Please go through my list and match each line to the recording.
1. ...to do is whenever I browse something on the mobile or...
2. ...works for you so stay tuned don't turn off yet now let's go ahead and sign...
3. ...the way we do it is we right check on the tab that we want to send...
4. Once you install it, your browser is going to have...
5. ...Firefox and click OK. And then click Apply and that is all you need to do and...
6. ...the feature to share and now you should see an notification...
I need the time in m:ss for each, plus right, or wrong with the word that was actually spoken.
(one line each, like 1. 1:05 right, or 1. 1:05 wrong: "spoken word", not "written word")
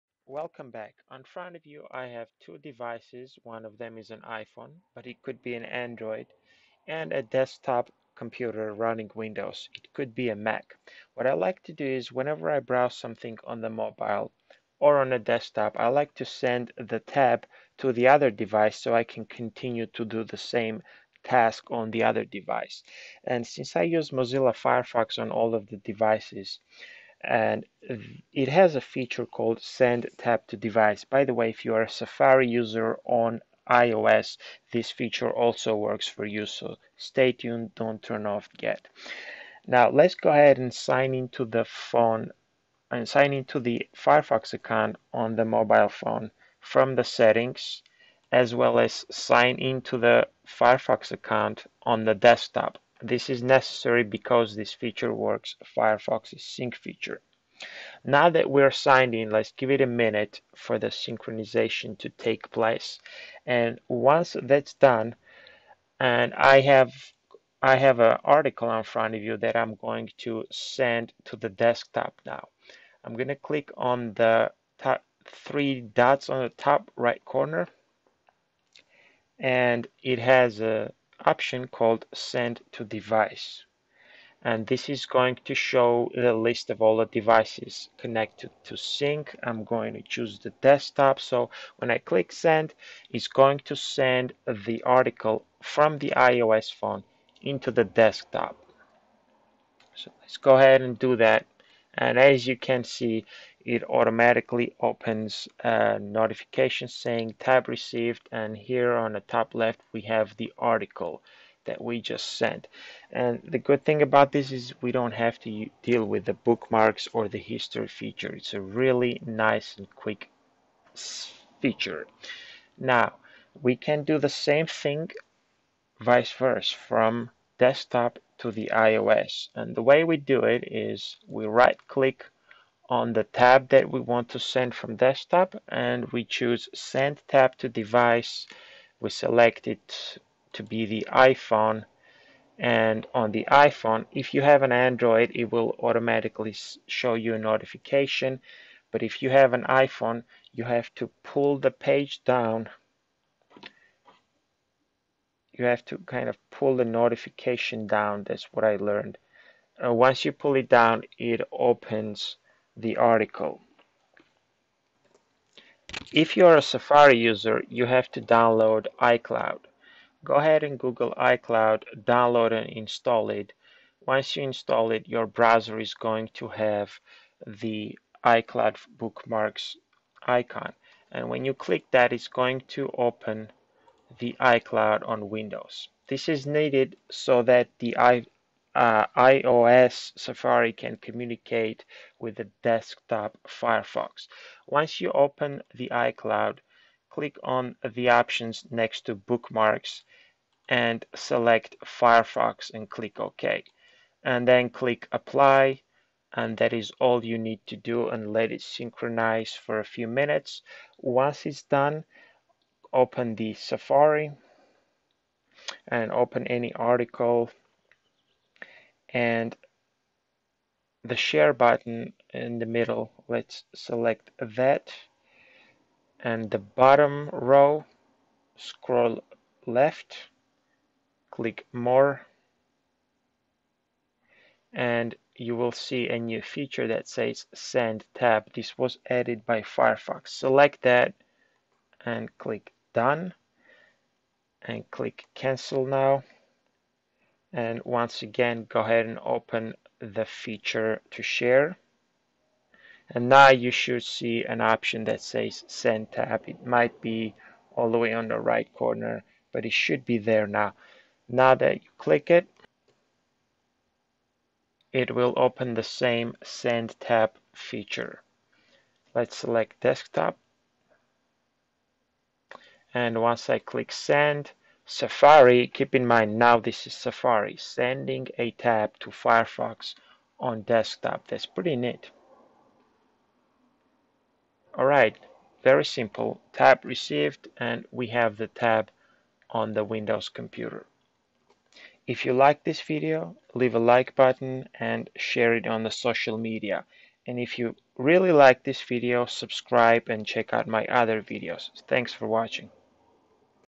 1. 0:11 right
2. 0:35 right
3. 2:09 wrong: "click", not "check"
4. 2:54 right
5. 3:21 right
6. 4:09 wrong: "option", not "notification".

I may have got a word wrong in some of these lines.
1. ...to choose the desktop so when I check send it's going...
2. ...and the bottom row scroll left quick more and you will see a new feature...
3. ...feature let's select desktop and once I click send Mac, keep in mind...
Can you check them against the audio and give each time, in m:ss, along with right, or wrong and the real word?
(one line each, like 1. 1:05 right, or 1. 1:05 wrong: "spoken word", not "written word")
1. 1:29 wrong: "click", not "check"
2. 3:46 wrong: "click", not "quick"
3. 4:27 wrong: "Safari", not "Mac".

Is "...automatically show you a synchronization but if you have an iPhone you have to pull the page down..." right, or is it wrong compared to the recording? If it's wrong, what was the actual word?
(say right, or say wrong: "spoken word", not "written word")
wrong: "notification", not "synchronization".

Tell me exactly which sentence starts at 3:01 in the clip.
And when you click that, it's going to open the iCloud on Windows.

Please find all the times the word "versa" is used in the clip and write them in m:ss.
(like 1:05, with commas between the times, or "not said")
2:06.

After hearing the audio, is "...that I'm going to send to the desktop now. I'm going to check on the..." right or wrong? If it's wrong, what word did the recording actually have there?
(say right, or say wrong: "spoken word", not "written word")
wrong: "click", not "check".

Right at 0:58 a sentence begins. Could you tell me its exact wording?
Now that we're signed in, let's give it a minute for the synchronization to take place.